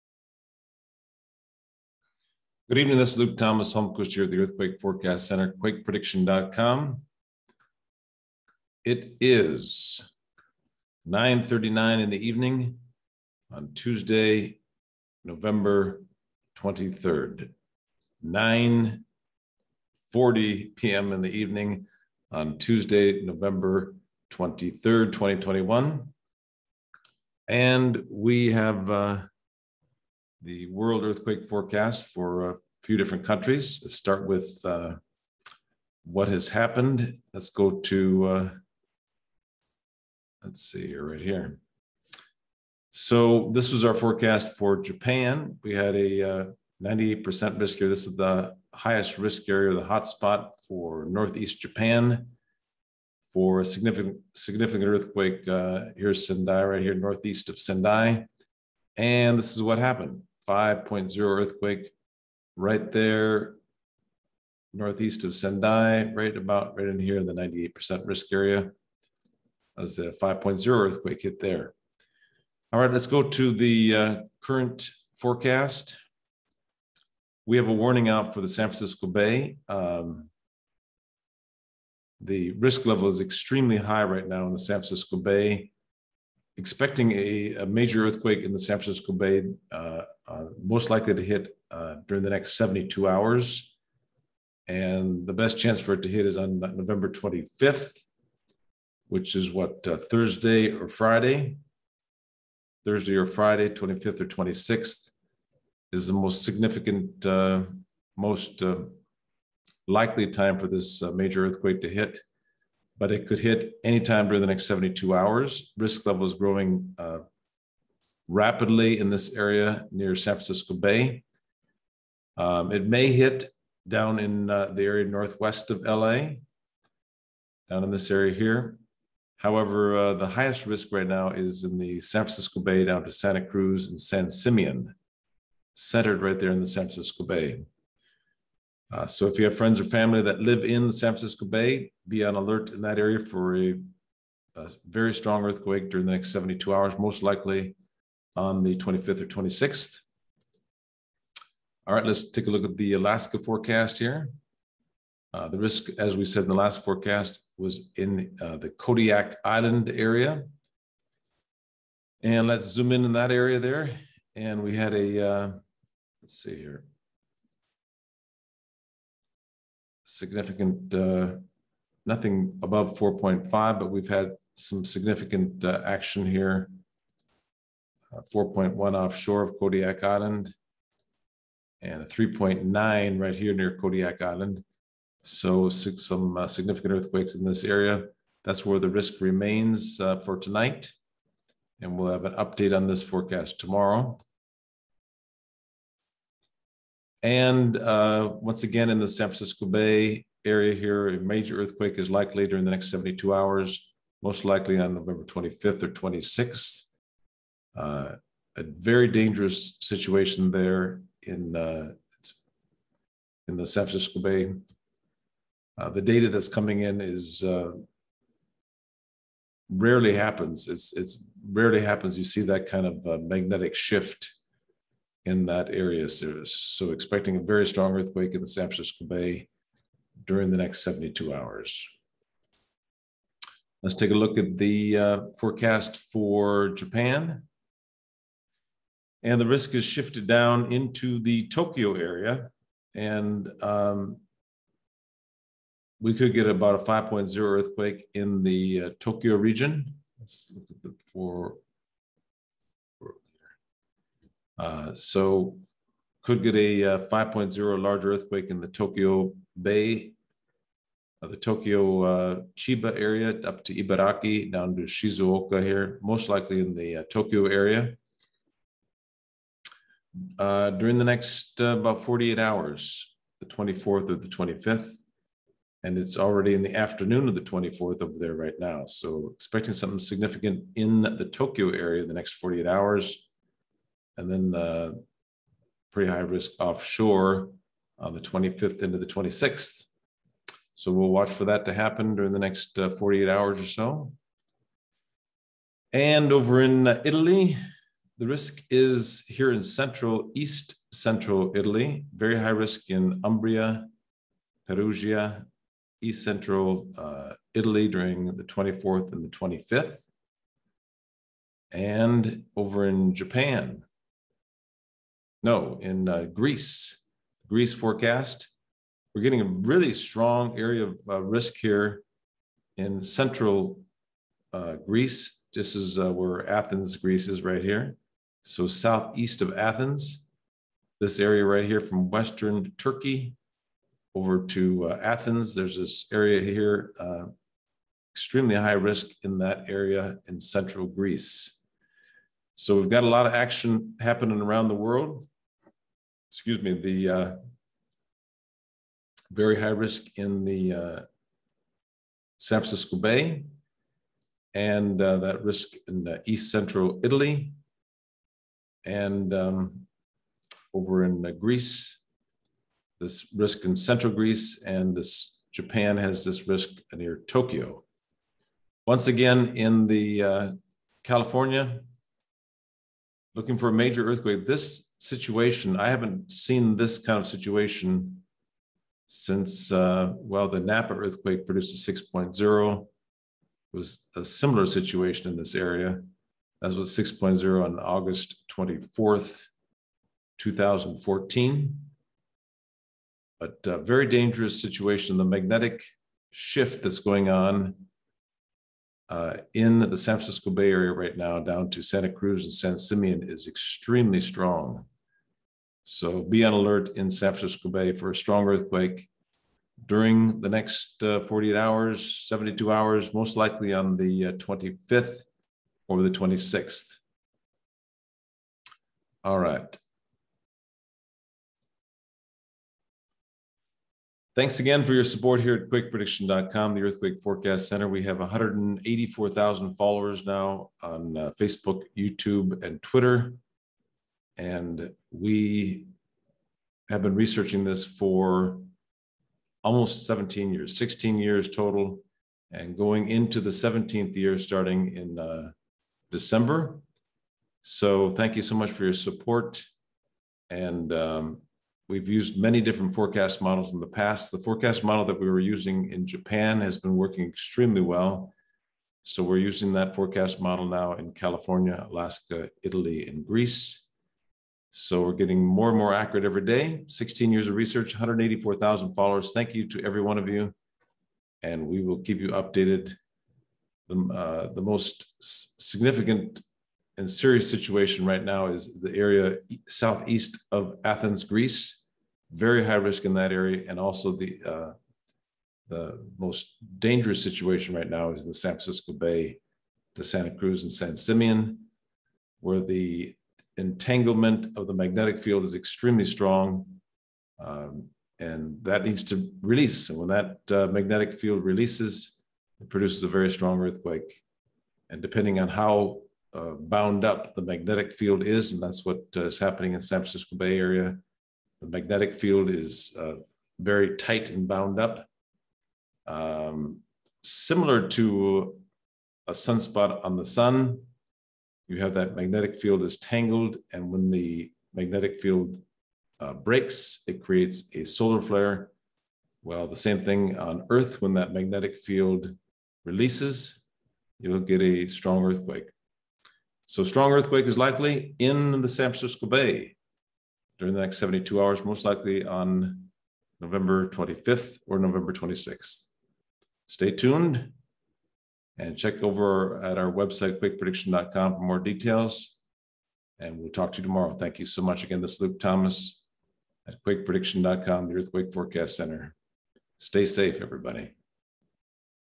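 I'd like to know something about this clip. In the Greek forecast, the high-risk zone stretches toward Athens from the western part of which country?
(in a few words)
Turkey.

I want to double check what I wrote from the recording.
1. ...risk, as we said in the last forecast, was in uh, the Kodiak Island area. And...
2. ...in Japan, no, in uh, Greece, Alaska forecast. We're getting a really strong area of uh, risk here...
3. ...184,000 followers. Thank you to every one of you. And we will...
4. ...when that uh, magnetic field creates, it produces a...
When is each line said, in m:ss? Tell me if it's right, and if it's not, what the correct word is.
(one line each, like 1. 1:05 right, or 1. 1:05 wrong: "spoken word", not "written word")
1. 2:35 right
2. 5:12 wrong: "Greece", not "Alaska"
3. 7:47 right
4. 8:19 wrong: "releases", not "creates".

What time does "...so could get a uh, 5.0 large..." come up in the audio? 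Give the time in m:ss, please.
4:14.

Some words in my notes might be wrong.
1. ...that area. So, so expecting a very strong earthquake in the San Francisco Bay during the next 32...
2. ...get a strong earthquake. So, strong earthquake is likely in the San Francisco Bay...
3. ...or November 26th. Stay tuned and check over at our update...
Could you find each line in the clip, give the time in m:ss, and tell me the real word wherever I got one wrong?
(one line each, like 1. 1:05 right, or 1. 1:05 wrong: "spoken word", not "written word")
1. 3:45 wrong: "72", not "32"
2. 8:54 right
3. 9:04 wrong: "website", not "update".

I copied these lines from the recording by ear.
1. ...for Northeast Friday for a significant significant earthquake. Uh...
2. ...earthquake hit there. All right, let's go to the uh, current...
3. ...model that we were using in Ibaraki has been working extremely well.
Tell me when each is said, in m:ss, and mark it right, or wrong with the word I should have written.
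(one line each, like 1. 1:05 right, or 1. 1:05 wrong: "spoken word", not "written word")
1. 0:50 wrong: "Japan", not "Friday"
2. 1:10 right
3. 7:34 wrong: "Japan", not "Ibaraki".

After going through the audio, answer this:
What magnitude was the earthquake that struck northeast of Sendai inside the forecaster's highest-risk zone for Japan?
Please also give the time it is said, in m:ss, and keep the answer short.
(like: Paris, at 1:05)
5.0, at 1:00.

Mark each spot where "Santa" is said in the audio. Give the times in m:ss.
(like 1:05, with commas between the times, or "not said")
2:13, 6:41, 8:10.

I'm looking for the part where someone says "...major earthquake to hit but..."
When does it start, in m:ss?
1:51.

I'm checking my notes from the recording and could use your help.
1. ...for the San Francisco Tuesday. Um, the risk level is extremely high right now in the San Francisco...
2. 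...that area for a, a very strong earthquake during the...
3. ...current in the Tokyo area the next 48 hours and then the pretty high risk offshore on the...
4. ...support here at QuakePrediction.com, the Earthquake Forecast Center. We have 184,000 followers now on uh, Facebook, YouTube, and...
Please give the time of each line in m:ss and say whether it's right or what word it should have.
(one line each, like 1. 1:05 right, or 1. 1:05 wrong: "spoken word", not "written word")
1. 1:18 wrong: "Bay", not "Tuesday"
2. 2:22 right
3. 4:39 wrong: "significant", not "current"
4. 7:05 right.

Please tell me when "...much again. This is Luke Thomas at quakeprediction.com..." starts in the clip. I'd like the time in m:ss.
9:14.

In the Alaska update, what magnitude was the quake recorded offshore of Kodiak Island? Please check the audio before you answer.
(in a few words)
4.1.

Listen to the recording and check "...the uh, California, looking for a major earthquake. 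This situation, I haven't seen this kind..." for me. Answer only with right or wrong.
right.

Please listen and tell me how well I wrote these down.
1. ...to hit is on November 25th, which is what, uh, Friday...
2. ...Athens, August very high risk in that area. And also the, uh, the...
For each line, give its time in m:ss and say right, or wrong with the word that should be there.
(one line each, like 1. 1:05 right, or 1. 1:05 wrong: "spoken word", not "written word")
1. 1:36 wrong: "Thursday", not "Friday"
2. 8:00 wrong: "Greece", not "August".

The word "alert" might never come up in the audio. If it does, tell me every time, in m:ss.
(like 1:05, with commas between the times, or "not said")
2:22, 6:46.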